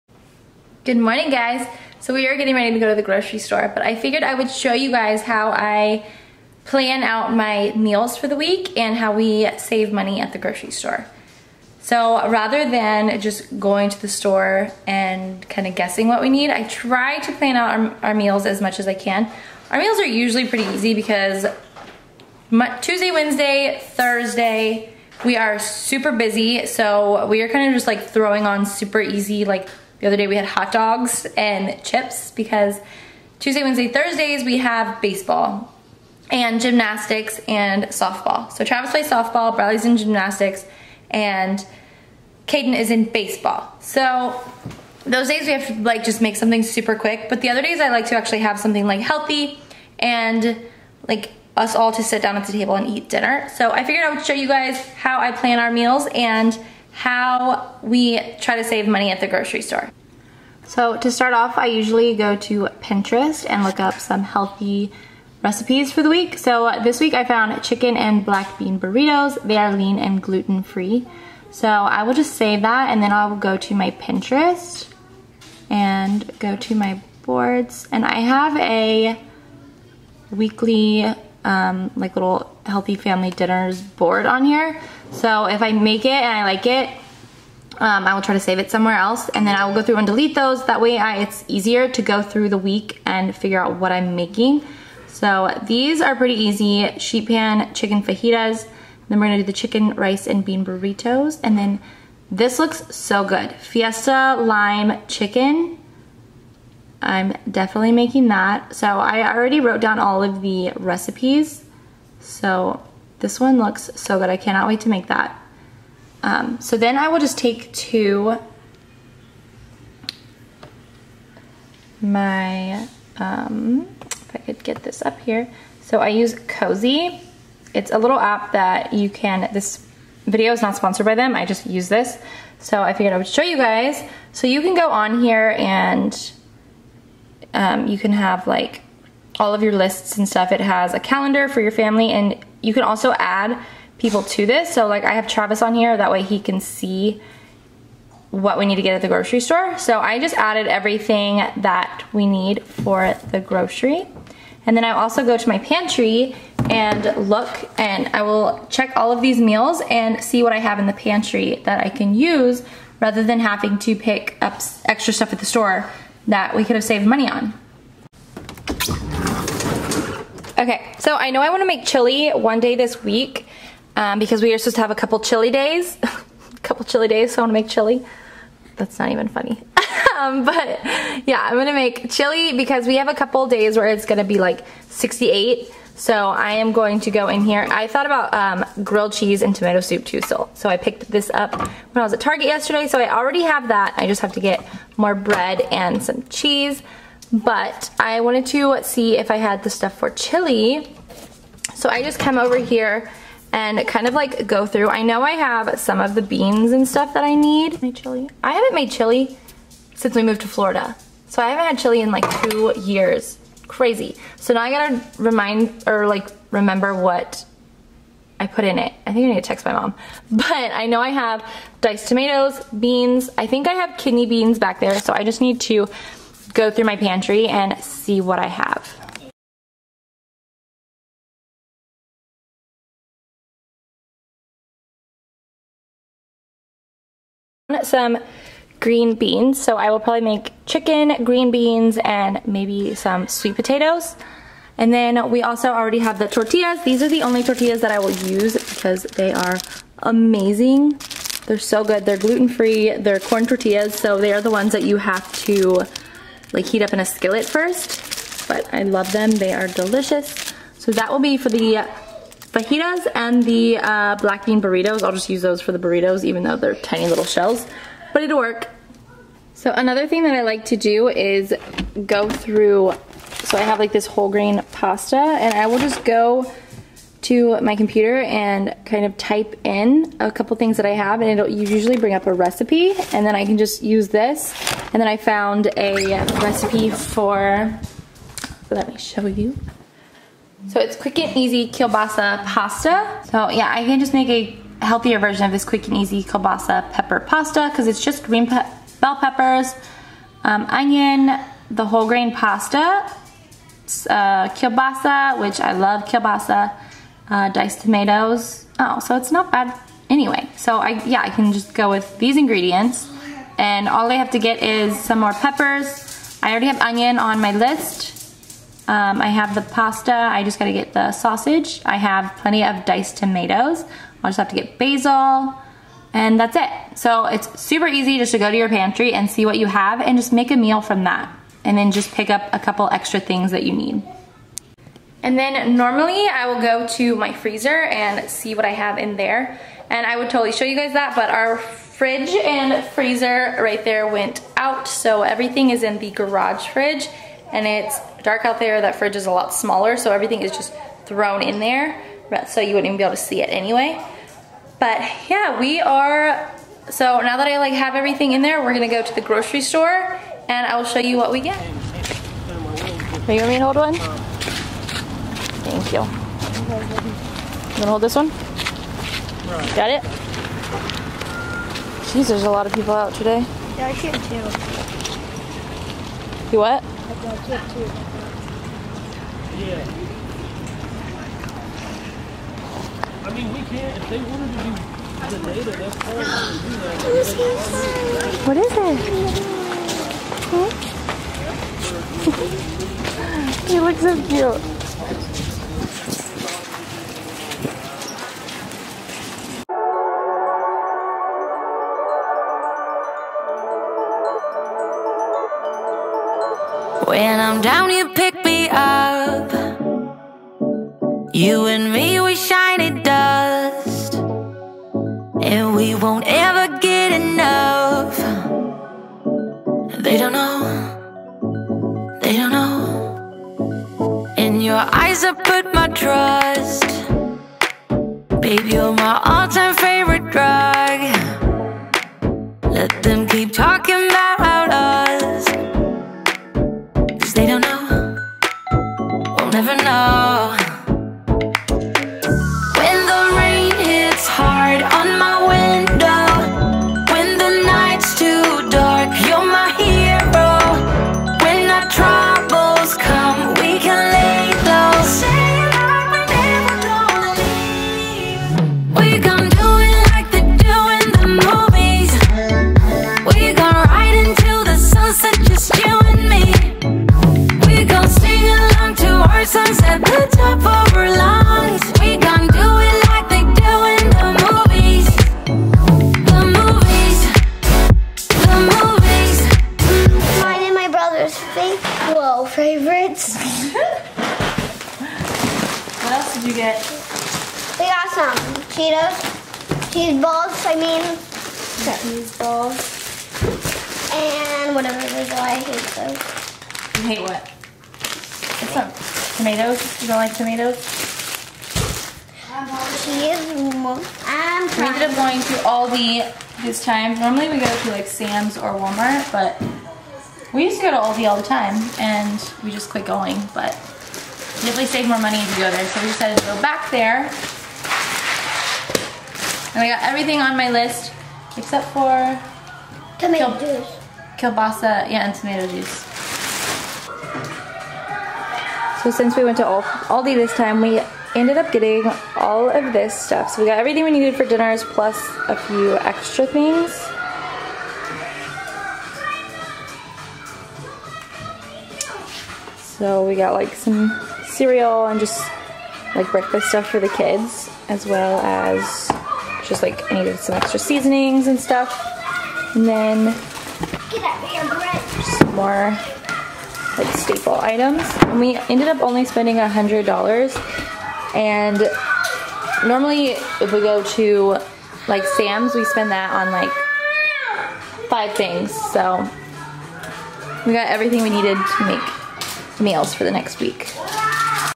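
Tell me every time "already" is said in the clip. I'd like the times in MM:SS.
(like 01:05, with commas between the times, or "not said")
01:49, 03:13, 04:05, 05:16.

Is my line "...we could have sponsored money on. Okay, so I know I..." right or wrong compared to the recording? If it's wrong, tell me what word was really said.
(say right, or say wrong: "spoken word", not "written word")
wrong: "saved", not "sponsored".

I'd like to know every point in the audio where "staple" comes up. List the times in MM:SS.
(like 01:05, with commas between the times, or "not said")
09:17.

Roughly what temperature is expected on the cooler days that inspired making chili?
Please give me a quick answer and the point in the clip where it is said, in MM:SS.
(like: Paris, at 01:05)
68, at 03:04.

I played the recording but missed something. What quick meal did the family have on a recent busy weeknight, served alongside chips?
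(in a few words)
Hot dogs.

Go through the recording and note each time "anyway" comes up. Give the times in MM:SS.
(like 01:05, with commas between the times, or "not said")
05:10, 05:53.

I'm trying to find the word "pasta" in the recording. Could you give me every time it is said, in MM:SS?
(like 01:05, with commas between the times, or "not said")
04:34, 04:52, 04:57, 05:02, 05:19.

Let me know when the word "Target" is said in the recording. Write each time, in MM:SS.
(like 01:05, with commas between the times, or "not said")
03:12.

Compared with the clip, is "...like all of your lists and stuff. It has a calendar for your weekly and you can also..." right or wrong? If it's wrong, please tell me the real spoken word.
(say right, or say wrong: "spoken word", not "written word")
wrong: "family", not "weekly".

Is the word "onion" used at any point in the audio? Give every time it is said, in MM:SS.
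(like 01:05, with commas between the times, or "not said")
05:00, 05:16.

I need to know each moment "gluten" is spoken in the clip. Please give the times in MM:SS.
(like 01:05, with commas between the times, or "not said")
01:10, 04:12.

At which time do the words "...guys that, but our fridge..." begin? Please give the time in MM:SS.
05:40.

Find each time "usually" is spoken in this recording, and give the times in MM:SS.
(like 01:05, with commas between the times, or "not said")
00:20, 01:01, 04:41.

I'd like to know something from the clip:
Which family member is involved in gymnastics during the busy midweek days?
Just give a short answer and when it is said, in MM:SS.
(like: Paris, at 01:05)
Bradley, at 00:39.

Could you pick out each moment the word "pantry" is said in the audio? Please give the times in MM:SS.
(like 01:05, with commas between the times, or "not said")
02:35, 02:40, 03:46, 05:28.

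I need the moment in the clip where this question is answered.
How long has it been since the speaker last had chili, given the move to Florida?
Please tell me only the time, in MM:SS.
03:32.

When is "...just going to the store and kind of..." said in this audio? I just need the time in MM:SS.
00:13.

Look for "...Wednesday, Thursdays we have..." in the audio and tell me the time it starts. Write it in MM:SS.
00:33.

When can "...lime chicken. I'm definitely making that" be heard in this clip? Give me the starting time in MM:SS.
01:44.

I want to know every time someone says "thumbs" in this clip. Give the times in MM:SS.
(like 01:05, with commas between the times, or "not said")
not said.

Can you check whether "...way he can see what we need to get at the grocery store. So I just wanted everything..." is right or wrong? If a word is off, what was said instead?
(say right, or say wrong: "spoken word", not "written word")
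wrong: "added", not "wanted".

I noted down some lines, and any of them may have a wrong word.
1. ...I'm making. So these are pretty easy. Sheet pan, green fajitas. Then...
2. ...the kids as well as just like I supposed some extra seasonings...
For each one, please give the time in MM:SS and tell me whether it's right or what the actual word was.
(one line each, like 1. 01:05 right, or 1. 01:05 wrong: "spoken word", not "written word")
1. 01:33 wrong: "chicken", not "green"
2. 09:06 wrong: "needed", not "supposed".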